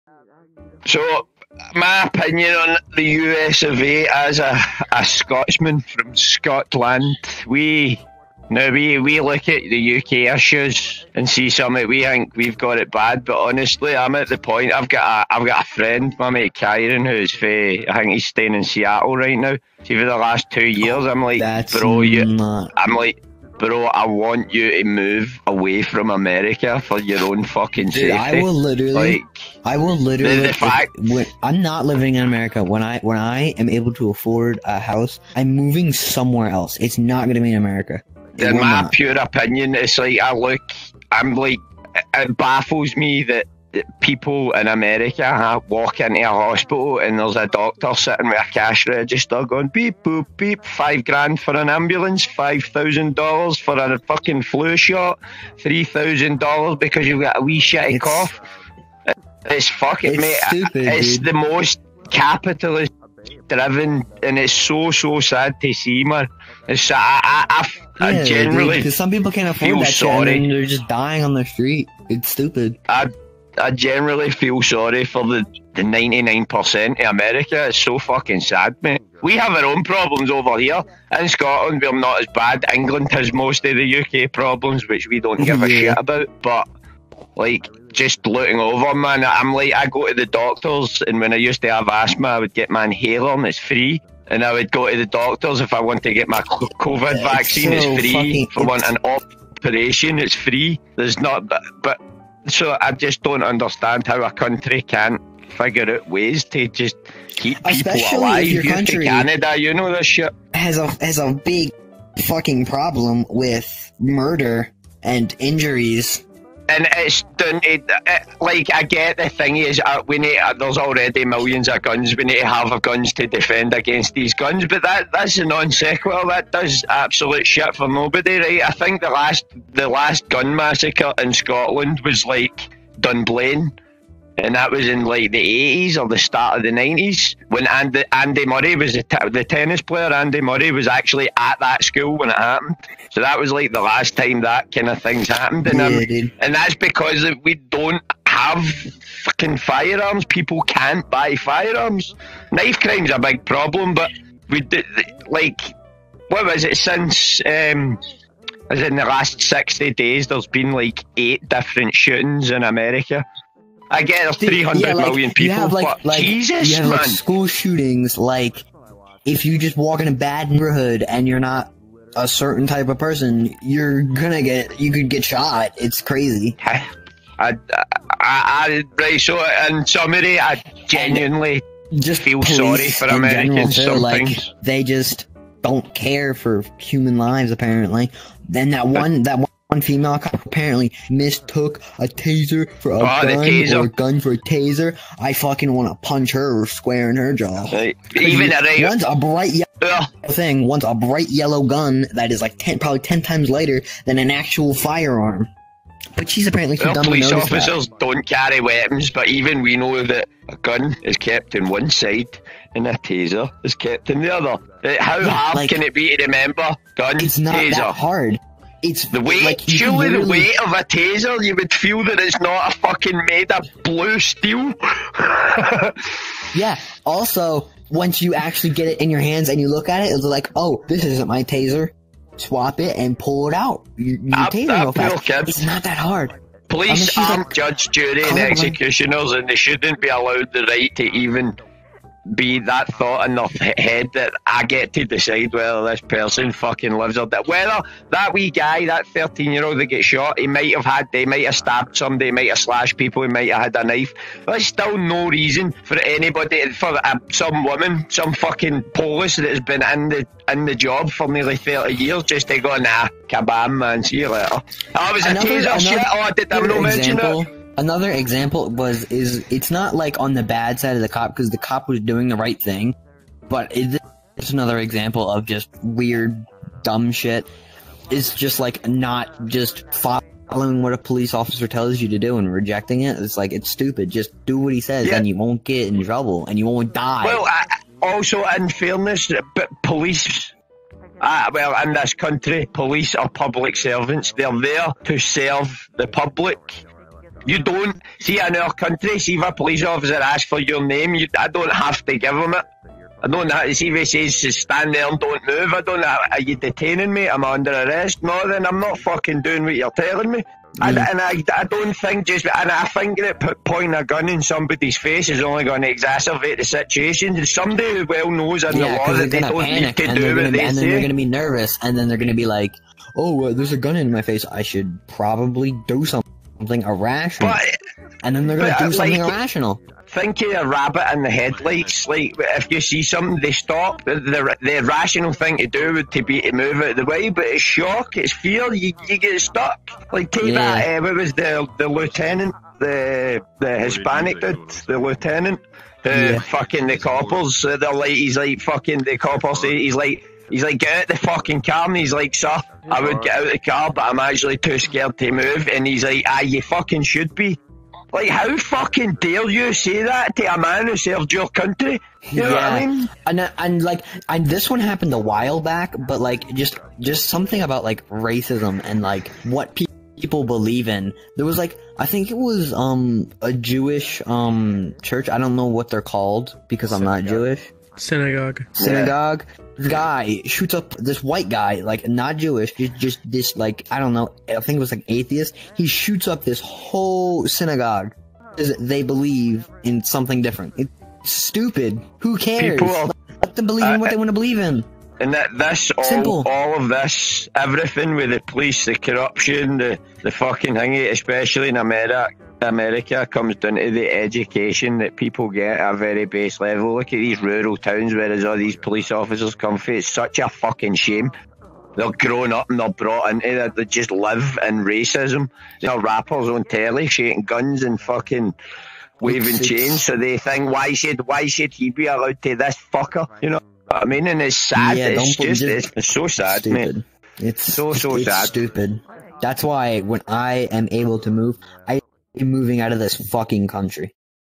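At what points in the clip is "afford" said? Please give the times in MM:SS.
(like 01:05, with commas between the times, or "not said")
00:34, 01:09.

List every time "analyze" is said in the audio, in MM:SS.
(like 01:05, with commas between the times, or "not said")
not said.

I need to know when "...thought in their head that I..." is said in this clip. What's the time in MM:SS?
04:02.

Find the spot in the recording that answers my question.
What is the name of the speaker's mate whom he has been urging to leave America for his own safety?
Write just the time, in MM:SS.
00:16.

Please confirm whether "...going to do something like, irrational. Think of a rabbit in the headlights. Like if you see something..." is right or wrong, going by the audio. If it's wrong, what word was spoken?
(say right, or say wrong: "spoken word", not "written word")
right.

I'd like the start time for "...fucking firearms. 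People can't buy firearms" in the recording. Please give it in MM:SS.
02:29.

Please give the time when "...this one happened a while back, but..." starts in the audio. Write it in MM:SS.
06:04.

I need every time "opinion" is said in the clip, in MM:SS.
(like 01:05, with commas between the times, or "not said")
00:02, 00:39.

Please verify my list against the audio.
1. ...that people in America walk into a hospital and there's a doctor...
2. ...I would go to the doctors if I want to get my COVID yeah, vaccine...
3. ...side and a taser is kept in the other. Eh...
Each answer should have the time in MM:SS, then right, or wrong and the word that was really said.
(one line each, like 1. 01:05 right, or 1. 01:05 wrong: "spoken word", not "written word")
1. 00:43 right
2. 01:34 right
3. 03:31 right.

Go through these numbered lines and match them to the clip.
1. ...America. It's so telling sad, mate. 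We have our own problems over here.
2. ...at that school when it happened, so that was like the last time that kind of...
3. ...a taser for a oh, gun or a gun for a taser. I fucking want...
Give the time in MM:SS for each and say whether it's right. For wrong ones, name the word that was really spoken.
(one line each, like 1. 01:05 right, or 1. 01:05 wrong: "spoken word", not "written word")
1. 01:17 wrong: "fucking", not "telling"
2. 02:21 right
3. 03:11 right.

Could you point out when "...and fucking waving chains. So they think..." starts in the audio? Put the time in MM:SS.
06:57.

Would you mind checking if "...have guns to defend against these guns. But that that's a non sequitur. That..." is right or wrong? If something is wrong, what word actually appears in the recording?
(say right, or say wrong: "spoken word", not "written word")
right.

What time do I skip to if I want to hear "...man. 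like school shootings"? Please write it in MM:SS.
02:46.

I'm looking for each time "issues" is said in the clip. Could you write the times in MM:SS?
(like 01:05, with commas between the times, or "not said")
00:10.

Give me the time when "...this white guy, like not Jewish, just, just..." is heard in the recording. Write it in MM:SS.
06:20.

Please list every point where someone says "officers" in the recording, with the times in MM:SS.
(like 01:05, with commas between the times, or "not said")
03:27, 04:41, 04:59, 06:49.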